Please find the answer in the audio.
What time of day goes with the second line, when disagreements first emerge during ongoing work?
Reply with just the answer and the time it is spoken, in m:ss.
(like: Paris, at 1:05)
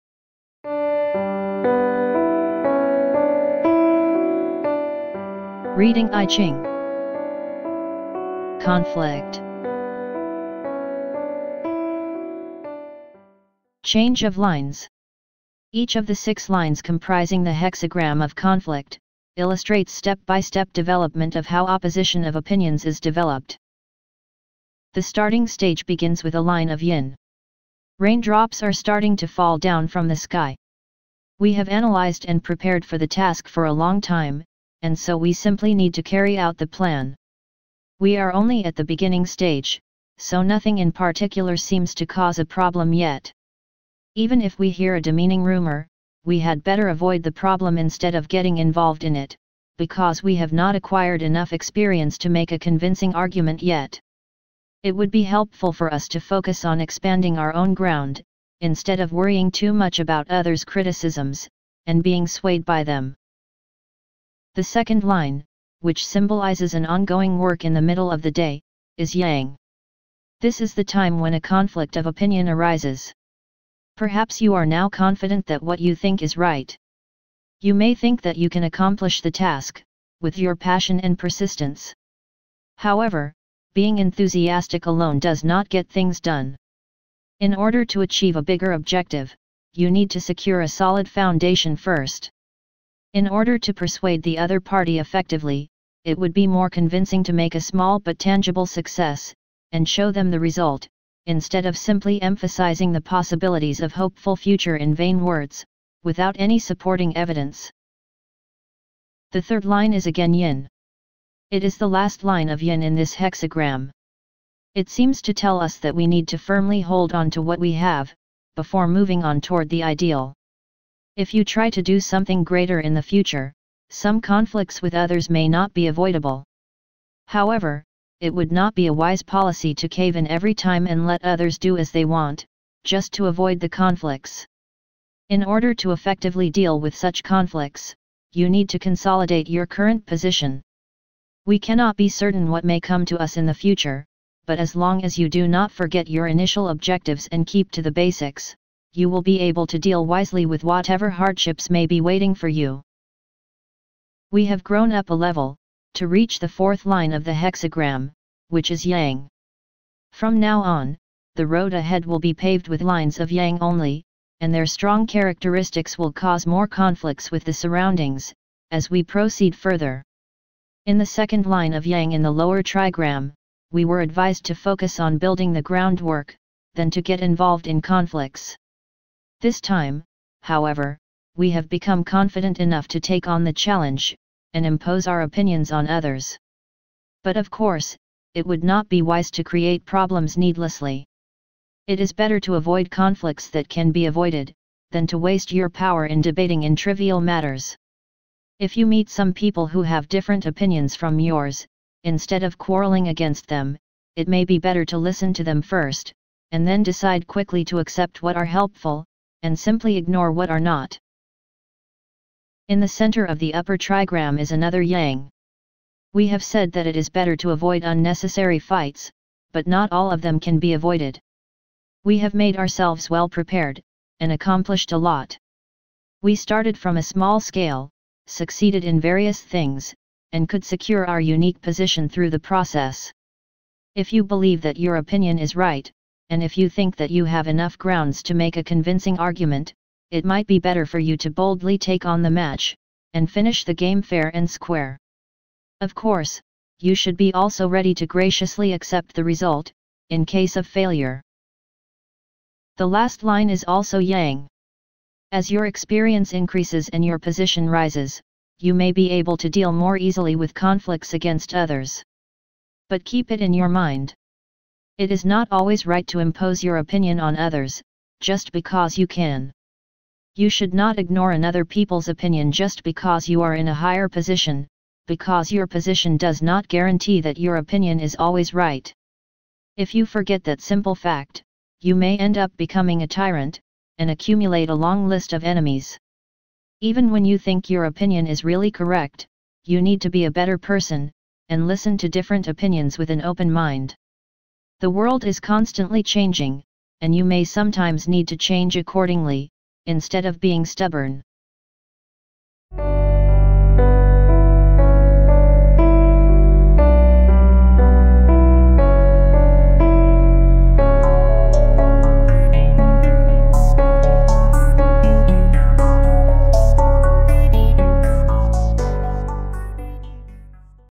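Middle of the day, at 1:07.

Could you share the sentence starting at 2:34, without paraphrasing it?
We have grown up a level, to reach the fourth line of the hexagram, which is Yang.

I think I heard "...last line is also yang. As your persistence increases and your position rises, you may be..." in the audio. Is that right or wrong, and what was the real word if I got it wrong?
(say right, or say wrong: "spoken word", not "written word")
wrong: "experience", not "persistence".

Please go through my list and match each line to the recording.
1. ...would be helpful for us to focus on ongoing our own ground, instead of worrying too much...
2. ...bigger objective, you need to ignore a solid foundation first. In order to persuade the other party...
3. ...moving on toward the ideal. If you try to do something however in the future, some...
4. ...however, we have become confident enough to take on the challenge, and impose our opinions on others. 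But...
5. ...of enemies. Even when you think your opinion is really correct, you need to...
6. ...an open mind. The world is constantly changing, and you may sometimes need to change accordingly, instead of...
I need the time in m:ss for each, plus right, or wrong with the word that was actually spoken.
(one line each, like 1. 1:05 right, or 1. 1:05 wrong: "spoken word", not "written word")
1. 0:54 wrong: "expanding", not "ongoing"
2. 1:28 wrong: "secure", not "ignore"
3. 1:58 wrong: "greater", not "however"
4. 3:00 right
5. 4:45 right
6. 4:53 right.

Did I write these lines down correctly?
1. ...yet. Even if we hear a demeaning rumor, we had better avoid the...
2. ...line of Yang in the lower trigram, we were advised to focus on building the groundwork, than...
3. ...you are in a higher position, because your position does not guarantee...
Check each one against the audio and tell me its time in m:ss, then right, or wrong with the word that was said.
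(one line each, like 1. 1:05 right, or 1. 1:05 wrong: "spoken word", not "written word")
1. 0:42 right
2. 2:51 right
3. 4:33 right.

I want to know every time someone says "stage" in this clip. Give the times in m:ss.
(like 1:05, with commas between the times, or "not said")
0:25, 0:39.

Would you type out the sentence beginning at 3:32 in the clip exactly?
In the center of the upper trigram is another yang.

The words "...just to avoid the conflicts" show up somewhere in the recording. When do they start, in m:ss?
2:12.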